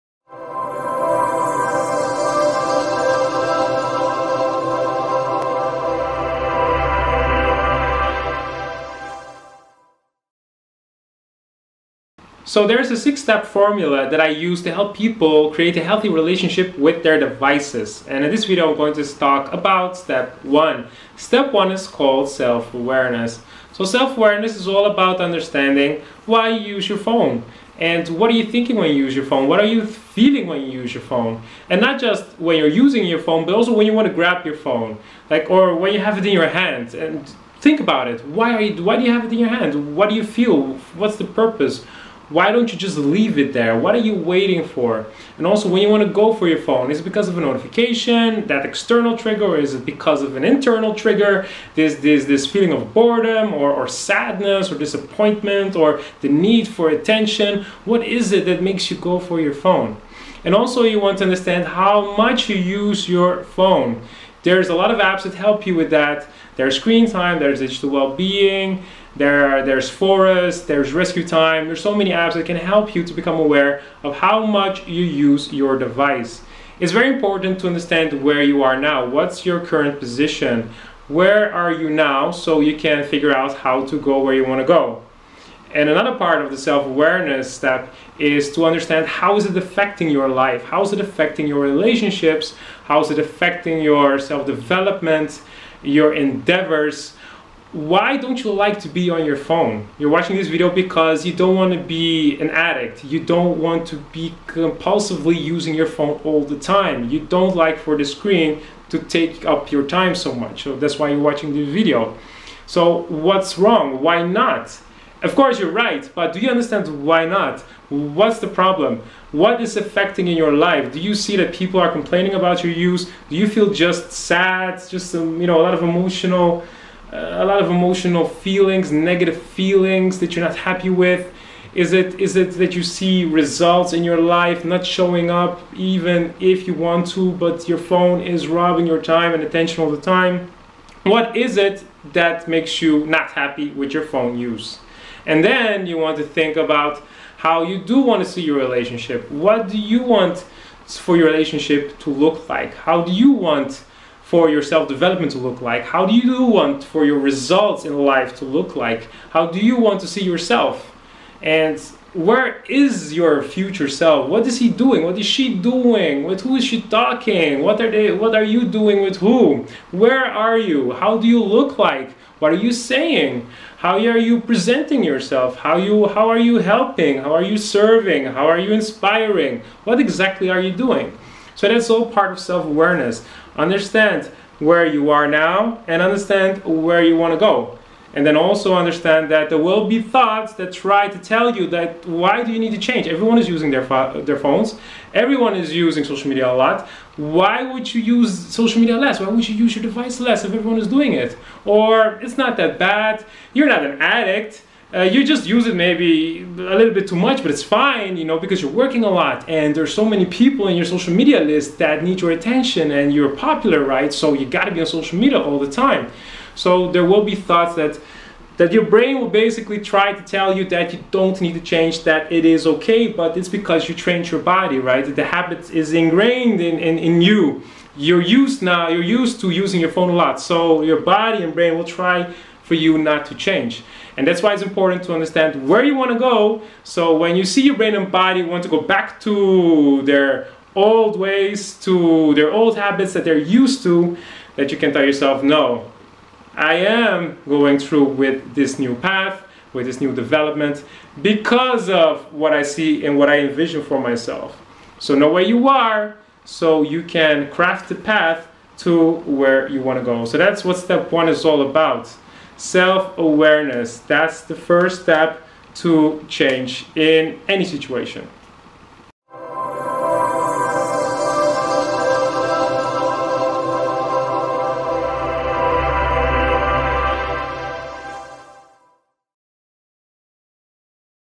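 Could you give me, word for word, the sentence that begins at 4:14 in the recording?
So know where you are, so you can craft the path to where you want to go.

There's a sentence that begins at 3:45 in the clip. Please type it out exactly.
The habit is ingrained in, in, in you.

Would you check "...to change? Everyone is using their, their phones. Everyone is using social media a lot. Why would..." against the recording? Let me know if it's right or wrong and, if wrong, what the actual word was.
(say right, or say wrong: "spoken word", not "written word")
right.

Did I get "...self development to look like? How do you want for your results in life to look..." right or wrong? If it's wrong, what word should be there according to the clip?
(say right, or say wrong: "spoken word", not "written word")
right.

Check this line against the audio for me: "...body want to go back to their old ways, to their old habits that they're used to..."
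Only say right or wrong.
right.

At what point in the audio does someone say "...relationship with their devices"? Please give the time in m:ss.
0:16.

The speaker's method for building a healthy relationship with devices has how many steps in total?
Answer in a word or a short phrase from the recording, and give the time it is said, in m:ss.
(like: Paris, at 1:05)
6, at 0:12.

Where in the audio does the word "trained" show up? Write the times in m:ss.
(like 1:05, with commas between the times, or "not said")
3:43.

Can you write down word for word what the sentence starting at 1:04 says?
There's a lot of apps that help you with that.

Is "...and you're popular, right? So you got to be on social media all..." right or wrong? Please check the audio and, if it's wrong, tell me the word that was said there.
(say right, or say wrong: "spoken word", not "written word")
right.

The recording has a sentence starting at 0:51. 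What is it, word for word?
This, this, this feeling of boredom or, or sadness or disappointment or the need for attention.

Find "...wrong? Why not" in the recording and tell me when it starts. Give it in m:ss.
1:53.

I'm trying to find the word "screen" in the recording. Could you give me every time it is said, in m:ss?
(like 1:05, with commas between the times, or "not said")
1:06, 1:48.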